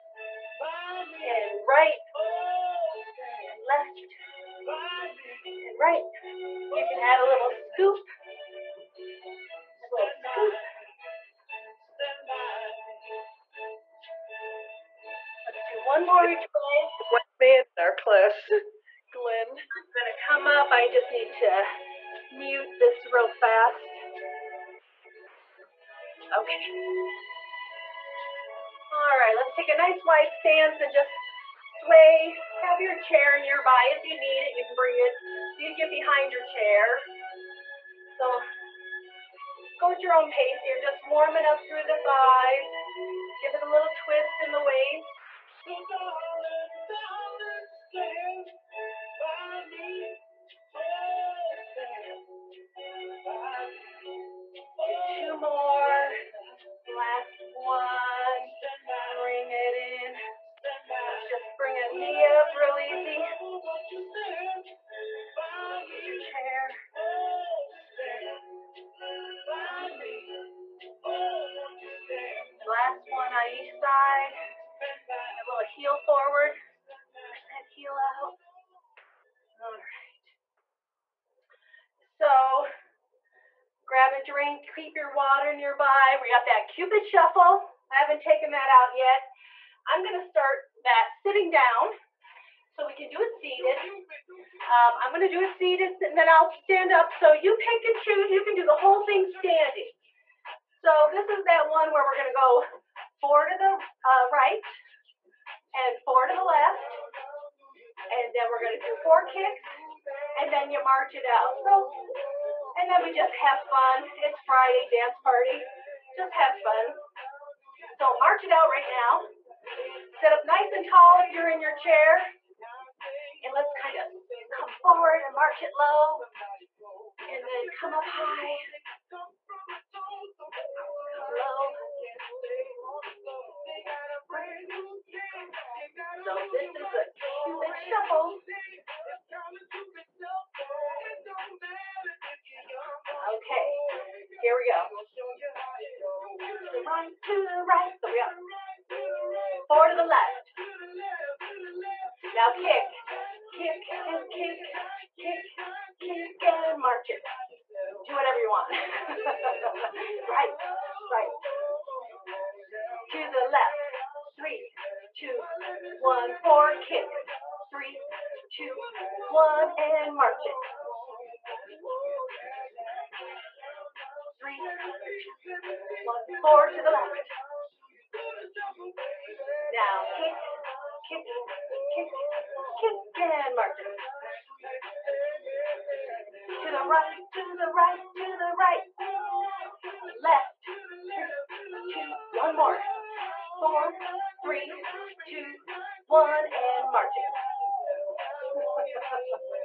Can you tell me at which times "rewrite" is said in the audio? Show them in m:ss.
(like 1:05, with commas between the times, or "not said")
not said.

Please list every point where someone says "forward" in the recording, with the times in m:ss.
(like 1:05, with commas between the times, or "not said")
1:16, 2:04.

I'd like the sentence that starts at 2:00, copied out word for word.
Sit up nice and tall if you're in your chair.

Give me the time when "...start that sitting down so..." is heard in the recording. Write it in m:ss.
1:30.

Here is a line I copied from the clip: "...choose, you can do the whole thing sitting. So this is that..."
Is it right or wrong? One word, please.
wrong.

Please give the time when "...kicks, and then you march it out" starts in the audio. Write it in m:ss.
1:49.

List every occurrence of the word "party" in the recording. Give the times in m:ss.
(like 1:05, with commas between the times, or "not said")
1:55.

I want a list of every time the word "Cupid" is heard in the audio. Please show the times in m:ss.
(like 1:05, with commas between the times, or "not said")
1:26, 2:17.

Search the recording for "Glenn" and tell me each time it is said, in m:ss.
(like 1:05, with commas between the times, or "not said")
0:19.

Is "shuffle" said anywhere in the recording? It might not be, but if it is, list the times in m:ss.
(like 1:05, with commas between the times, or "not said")
1:27, 2:17.